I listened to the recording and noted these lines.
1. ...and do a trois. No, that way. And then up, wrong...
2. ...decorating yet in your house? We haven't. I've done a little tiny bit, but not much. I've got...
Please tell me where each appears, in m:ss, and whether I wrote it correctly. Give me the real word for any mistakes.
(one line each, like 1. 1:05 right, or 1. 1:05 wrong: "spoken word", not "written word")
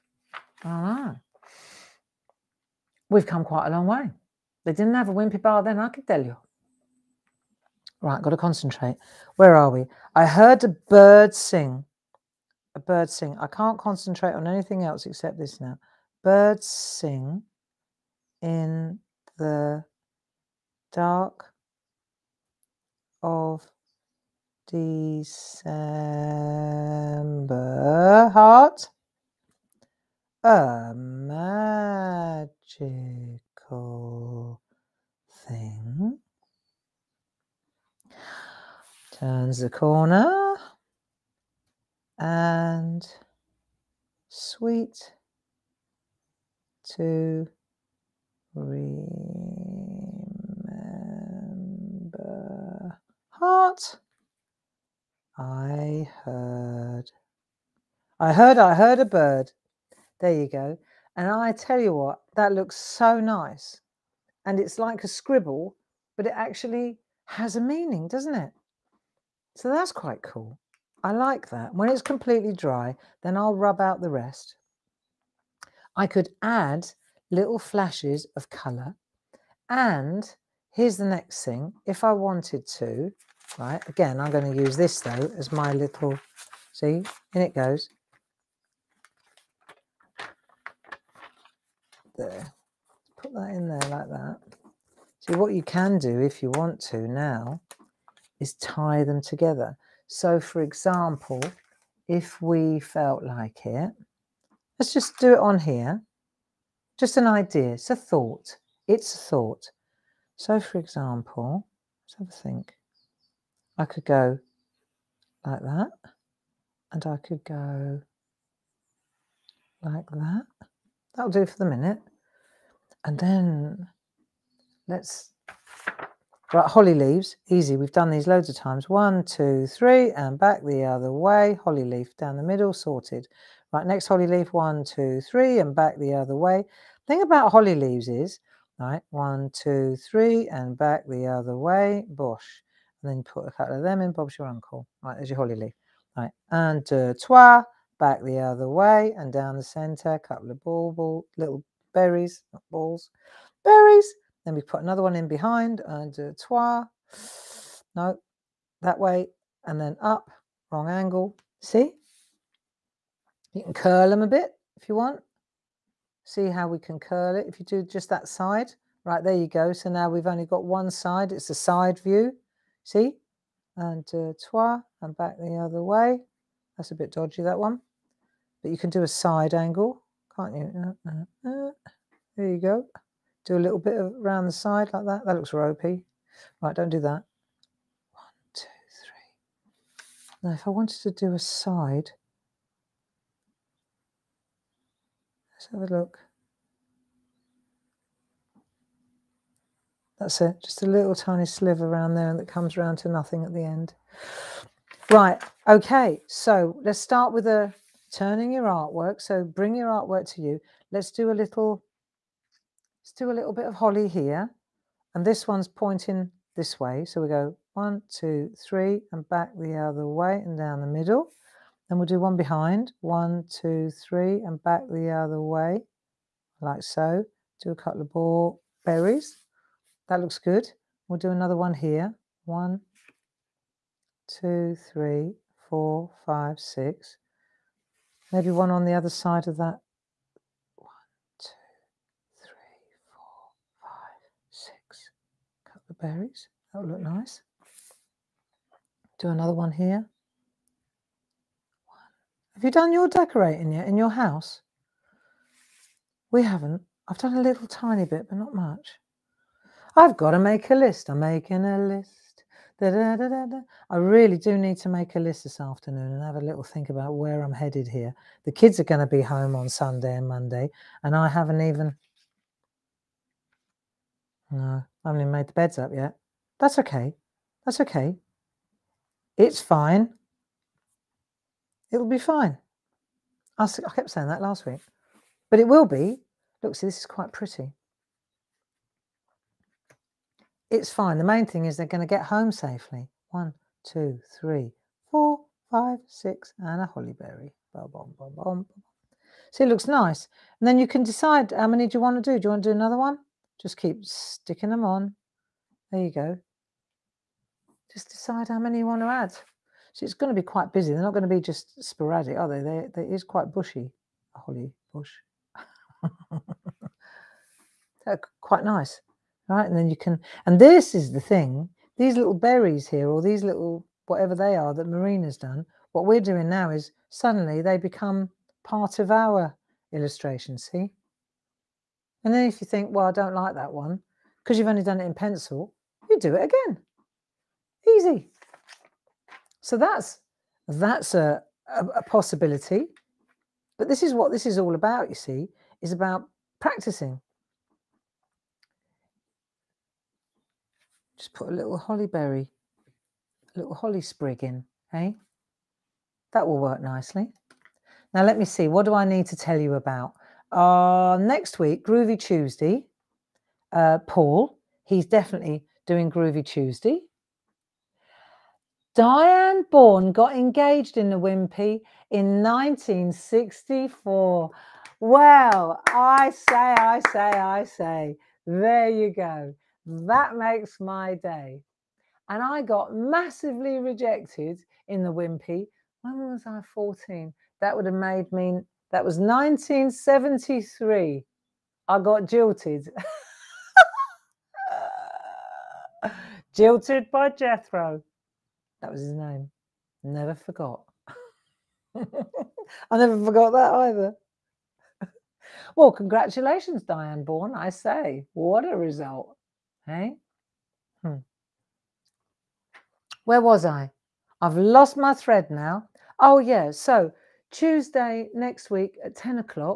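1. 2:35 right
2. 4:13 right.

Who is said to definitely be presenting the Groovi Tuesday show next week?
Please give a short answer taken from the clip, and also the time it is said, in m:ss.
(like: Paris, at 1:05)
Paul, at 6:04.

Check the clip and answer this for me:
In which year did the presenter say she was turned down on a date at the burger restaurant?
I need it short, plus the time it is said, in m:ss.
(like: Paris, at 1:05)
1973, at 6:29.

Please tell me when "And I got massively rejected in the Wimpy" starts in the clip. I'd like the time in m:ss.
6:22.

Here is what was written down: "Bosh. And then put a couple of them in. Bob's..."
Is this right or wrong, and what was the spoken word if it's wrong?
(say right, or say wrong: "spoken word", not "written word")
right.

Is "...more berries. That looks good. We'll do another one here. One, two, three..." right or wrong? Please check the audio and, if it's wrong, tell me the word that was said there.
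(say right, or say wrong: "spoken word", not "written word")
right.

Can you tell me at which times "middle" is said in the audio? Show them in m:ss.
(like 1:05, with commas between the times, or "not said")
2:12, 3:40.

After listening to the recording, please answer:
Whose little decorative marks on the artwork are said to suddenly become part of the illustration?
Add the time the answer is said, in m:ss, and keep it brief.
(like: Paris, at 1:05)
Marina, at 5:24.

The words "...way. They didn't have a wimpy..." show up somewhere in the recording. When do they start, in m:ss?
0:03.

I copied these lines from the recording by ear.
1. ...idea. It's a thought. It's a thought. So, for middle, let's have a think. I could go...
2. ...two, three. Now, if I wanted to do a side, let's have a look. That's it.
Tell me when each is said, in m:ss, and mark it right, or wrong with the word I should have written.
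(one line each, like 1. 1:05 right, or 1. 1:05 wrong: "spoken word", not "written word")
1. 1:47 wrong: "example", not "middle"
2. 3:08 right.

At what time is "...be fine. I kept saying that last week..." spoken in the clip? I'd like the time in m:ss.
4:42.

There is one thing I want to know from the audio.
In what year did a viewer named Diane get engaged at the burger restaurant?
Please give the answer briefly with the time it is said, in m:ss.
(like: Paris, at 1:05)
1964, at 6:12.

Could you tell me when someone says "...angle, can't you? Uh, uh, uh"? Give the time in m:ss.
2:59.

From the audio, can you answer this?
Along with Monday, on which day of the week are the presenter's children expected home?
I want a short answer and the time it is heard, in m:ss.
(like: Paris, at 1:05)
Sunday, at 4:29.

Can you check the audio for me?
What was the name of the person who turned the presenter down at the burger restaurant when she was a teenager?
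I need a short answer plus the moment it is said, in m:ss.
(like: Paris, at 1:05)
Jethro, at 6:37.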